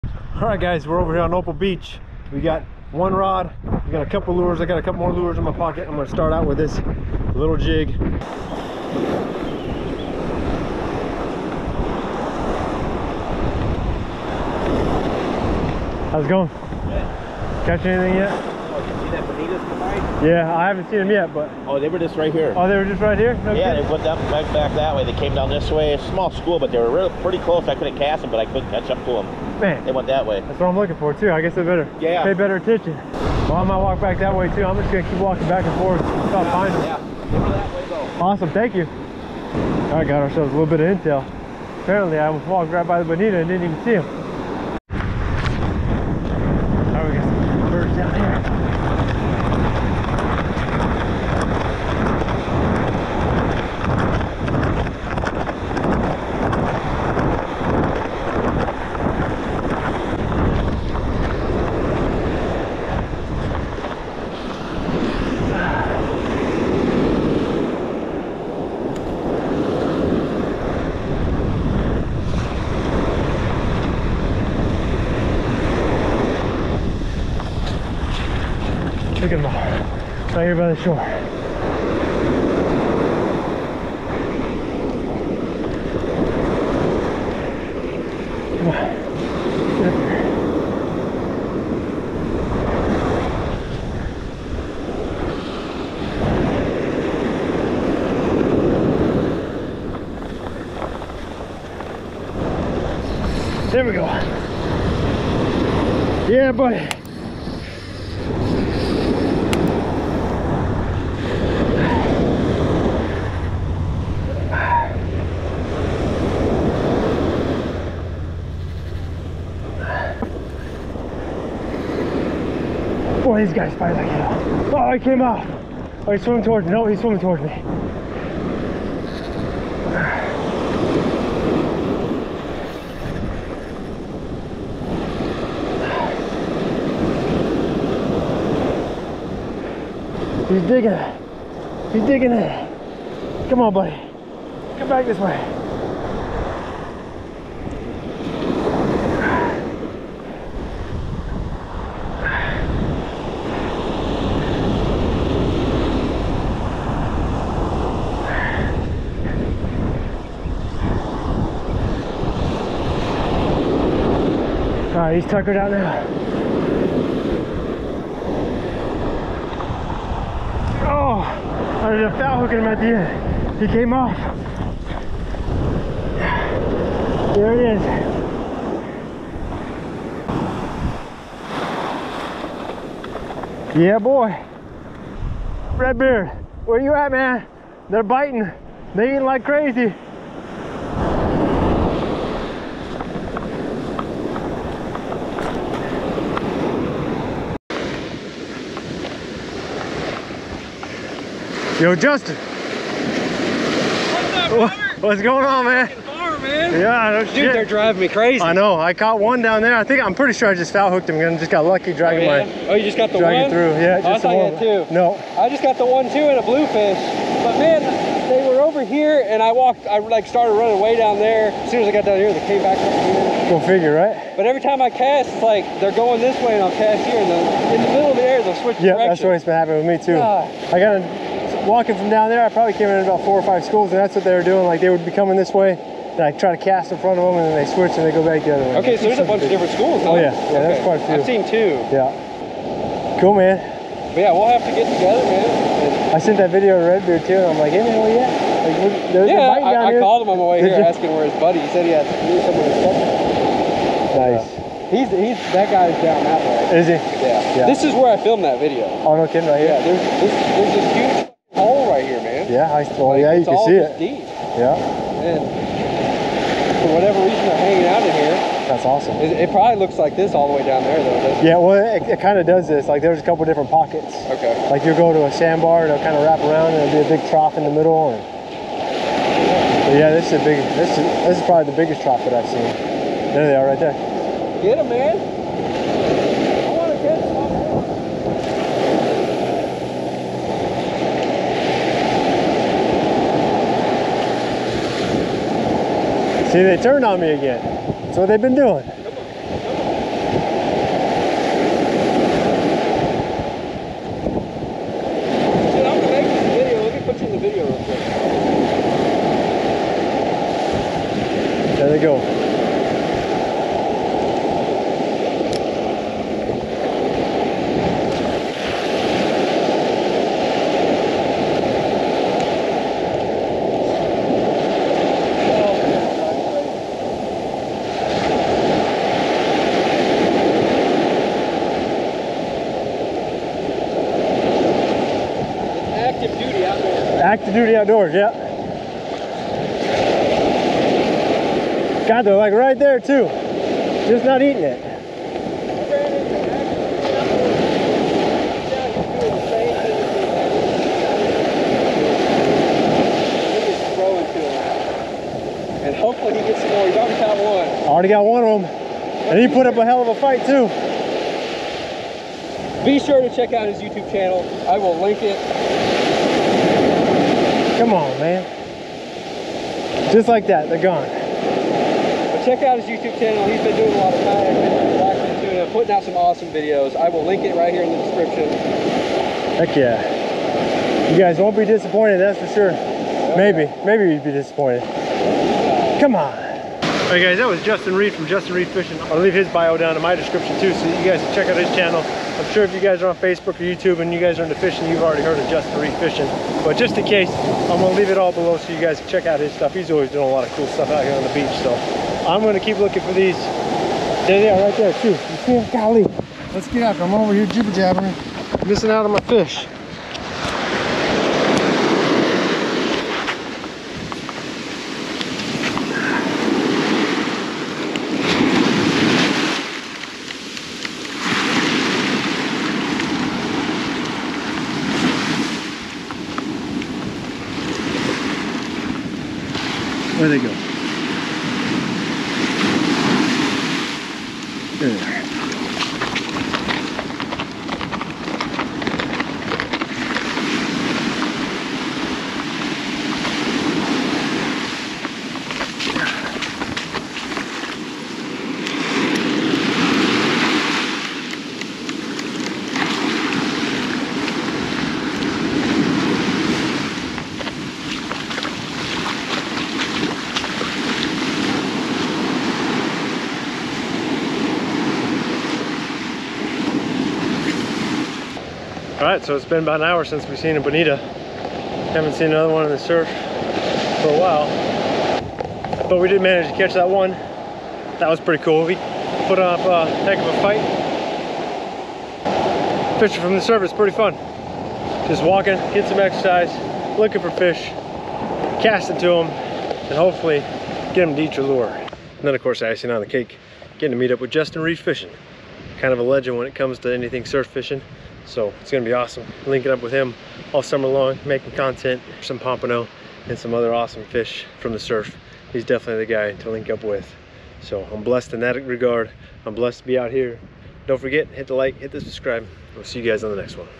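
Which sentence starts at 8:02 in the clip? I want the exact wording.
Fishing from the surface, pretty fun.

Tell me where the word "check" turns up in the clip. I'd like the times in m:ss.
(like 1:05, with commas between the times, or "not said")
6:03, 6:12, 6:31, 6:39.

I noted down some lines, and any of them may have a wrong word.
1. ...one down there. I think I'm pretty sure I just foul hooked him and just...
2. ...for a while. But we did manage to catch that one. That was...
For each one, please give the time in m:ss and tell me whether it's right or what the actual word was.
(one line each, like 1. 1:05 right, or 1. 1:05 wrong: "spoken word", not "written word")
1. 3:29 right
2. 7:53 right.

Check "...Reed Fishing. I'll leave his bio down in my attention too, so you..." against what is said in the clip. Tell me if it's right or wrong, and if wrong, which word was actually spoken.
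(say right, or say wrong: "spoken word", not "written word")
wrong: "description", not "attention".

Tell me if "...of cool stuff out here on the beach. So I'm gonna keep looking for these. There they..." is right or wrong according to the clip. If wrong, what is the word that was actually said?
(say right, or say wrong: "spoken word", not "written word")
right.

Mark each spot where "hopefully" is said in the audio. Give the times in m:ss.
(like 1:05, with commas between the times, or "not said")
5:55, 8:09.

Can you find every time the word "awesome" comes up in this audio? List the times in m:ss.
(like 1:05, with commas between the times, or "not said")
0:38, 4:28, 6:16, 8:18, 8:23.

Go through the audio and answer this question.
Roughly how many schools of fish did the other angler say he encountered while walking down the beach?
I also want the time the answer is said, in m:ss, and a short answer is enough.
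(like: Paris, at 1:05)
4 or 5, at 3:53.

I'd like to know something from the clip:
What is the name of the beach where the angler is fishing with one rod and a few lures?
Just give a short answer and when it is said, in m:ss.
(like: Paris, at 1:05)
Opal Beach, at 0:01.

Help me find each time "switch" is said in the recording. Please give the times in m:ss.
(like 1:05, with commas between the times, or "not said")
3:48, 3:57.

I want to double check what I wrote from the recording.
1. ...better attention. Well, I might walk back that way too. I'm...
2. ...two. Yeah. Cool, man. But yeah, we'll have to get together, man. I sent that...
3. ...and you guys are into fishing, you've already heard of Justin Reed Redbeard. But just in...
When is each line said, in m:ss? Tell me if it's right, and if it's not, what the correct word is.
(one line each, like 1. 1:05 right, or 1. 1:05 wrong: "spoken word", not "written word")
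1. 0:32 right
2. 4:01 right
3. 6:33 wrong: "Fishing", not "Redbeard".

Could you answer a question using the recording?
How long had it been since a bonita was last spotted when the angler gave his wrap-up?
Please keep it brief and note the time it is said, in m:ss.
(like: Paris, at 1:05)
about an hour, at 7:49.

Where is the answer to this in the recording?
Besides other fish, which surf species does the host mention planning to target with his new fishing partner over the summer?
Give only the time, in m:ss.
8:22.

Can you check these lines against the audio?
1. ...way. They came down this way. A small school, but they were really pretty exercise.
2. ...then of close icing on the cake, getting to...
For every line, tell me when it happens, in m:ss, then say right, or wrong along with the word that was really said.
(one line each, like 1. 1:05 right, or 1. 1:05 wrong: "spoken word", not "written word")
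1. 0:24 wrong: "close", not "exercise"
2. 8:12 wrong: "course", not "close".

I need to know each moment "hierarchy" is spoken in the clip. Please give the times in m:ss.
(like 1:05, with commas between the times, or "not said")
not said.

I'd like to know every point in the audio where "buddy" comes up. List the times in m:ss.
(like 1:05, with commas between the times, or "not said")
1:46, 2:23, 4:11.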